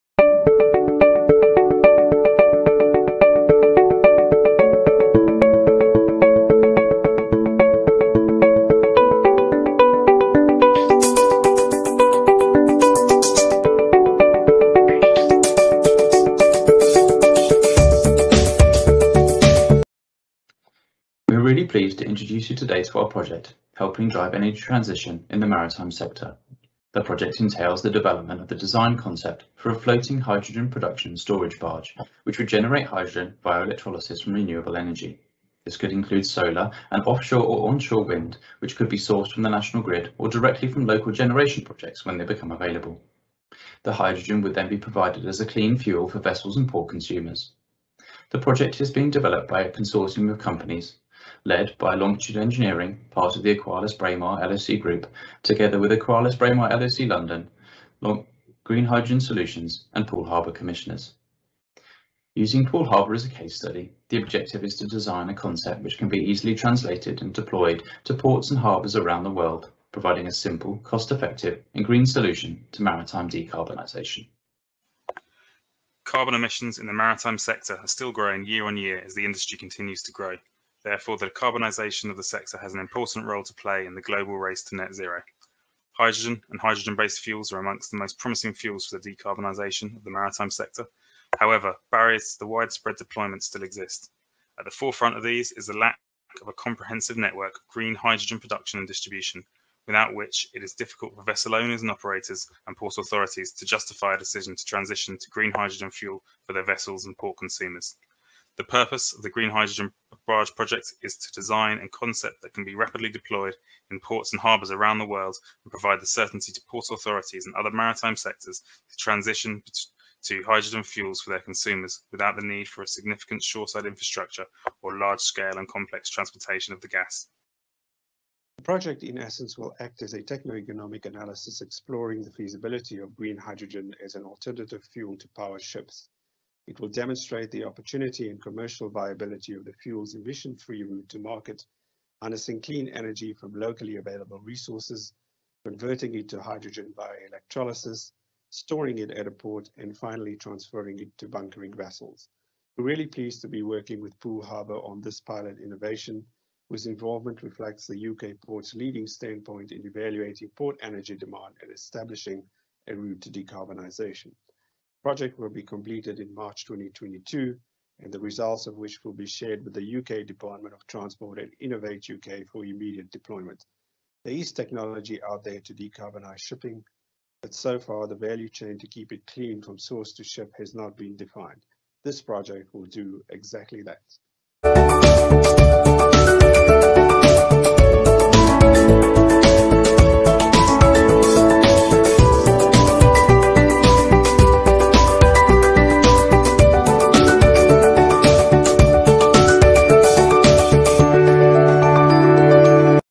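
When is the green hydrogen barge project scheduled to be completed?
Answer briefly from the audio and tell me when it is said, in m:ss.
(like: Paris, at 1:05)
March 2022, at 2:46.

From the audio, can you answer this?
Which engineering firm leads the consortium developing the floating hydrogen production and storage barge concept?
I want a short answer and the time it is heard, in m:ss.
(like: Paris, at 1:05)
Longitude Engineering, at 0:51.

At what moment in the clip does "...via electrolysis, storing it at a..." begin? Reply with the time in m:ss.
2:26.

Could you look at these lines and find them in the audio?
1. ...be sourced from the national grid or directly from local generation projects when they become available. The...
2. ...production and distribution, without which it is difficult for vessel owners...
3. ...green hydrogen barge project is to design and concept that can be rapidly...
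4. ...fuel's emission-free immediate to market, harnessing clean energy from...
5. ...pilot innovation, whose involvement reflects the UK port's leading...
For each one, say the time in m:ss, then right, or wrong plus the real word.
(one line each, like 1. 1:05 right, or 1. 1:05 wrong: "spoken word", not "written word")
1. 0:38 right
2. 1:38 right
3. 1:49 right
4. 2:19 wrong: "route", not "immediate"
5. 2:35 right.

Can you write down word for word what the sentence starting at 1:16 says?
Carbon emissions in the maritime sector are still growing year on year as the industry continues to grow.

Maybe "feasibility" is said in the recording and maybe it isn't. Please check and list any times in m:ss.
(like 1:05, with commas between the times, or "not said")
2:12.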